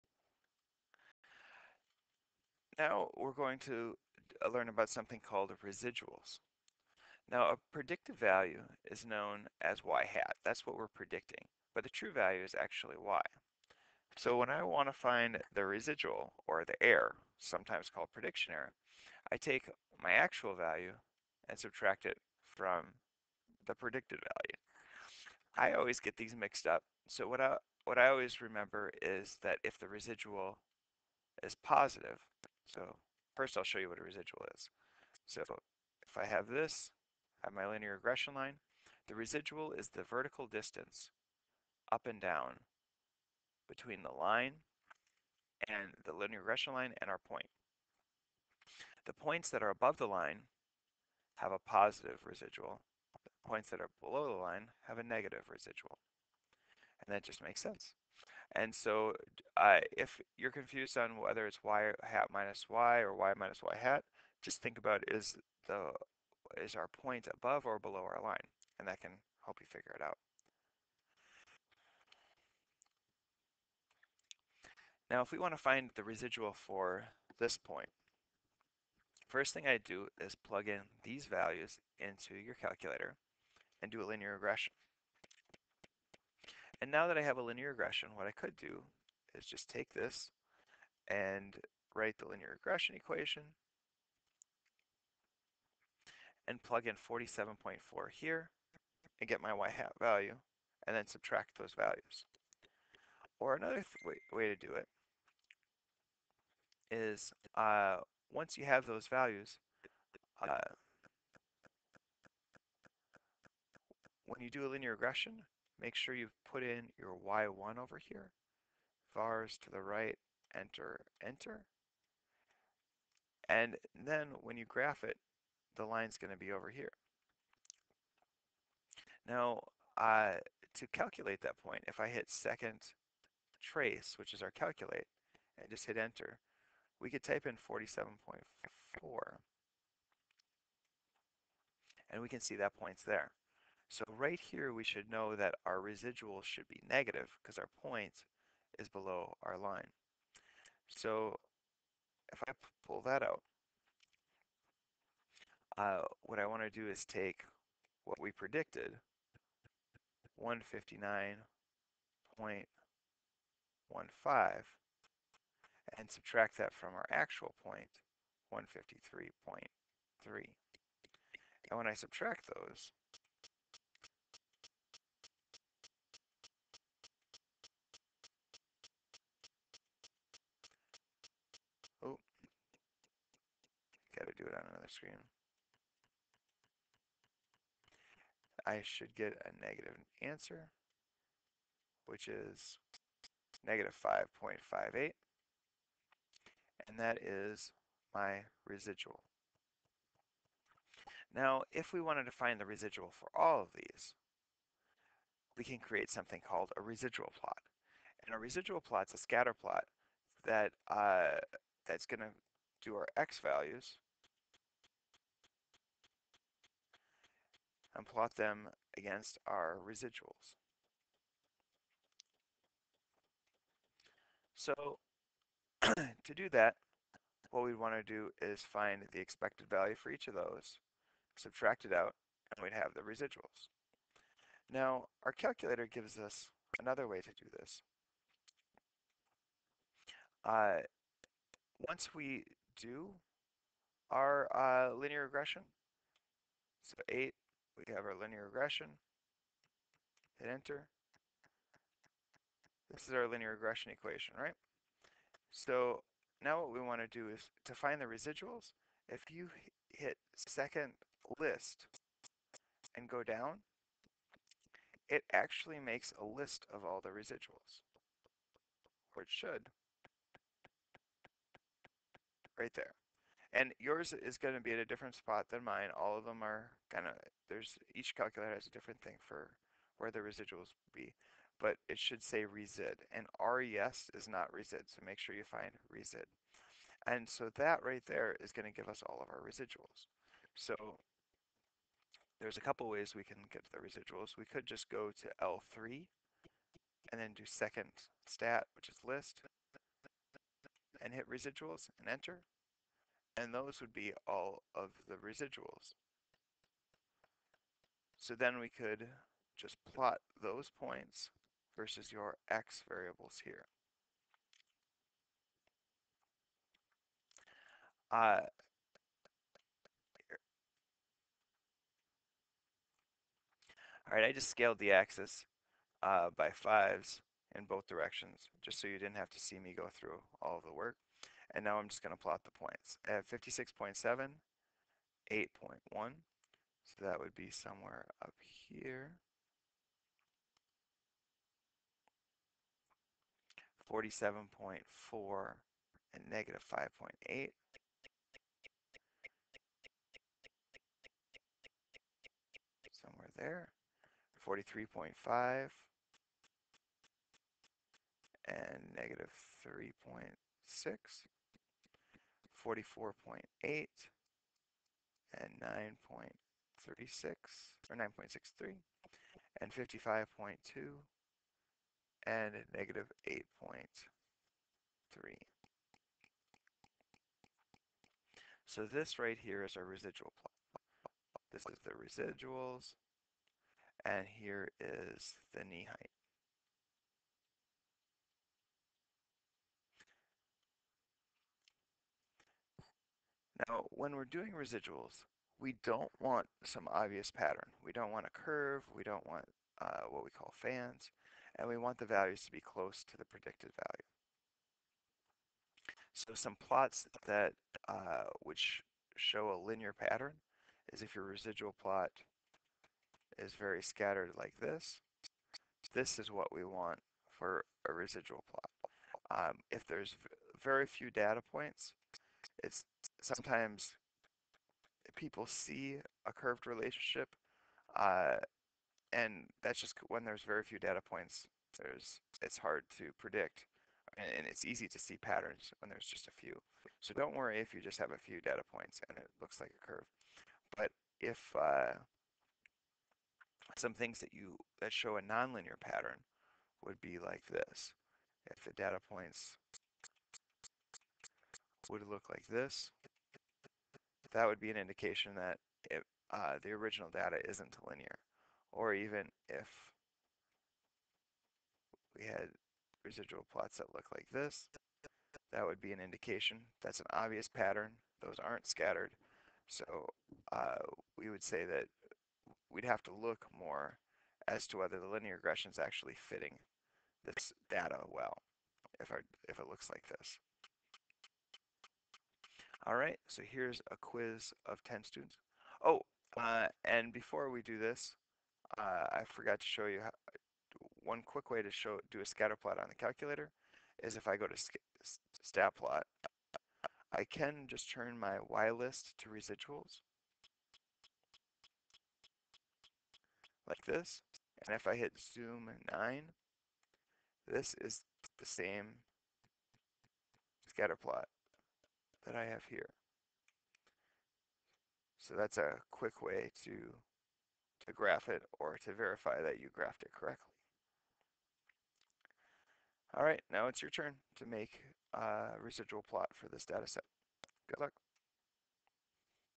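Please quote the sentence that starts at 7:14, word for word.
And it's easy to see patterns when there's just a few.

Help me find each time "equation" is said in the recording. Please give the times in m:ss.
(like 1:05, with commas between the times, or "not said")
1:32, 4:13.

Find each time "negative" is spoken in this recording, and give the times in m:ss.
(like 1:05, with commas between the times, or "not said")
0:55, 2:26, 3:09, 3:13, 6:12.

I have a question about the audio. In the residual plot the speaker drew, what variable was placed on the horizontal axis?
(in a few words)
knee height.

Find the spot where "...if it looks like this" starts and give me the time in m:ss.
7:59.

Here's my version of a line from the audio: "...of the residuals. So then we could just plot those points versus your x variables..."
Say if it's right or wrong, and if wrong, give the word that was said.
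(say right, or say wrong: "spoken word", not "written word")
right.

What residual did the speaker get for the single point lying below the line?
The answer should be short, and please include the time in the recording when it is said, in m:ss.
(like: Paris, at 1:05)
-5.58, at 3:13.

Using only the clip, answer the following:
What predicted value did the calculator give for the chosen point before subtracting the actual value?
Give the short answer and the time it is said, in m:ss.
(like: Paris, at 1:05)
159.15, at 2:40.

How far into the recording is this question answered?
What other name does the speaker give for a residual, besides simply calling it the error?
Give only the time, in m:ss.
0:18.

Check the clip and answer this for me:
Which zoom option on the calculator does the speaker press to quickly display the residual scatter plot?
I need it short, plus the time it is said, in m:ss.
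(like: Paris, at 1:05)
zoom nine, at 8:25.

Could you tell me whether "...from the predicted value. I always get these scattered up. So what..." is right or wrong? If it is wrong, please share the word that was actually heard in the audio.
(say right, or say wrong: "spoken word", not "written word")
wrong: "mixed", not "scattered".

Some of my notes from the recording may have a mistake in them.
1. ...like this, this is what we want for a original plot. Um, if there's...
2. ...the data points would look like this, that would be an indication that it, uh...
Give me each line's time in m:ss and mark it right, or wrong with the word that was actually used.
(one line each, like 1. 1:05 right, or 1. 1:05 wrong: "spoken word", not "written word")
1. 6:54 wrong: "residual", not "original"
2. 7:28 right.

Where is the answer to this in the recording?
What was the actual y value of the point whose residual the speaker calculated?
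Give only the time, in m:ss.
2:48.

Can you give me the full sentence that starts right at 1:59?
Vars to the right, enter, enter.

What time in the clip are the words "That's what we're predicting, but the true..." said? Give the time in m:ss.
0:10.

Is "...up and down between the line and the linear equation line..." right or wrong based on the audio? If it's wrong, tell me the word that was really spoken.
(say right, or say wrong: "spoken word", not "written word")
wrong: "regression", not "equation".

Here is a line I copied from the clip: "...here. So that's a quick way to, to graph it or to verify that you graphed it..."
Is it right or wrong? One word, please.
right.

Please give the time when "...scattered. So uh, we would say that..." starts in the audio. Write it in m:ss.
7:48.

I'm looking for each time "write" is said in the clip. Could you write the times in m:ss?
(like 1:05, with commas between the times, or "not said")
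1:31.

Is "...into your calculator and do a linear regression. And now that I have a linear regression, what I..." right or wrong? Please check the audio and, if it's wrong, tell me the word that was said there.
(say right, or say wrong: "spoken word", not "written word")
right.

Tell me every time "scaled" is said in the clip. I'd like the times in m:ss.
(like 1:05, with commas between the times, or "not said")
5:24.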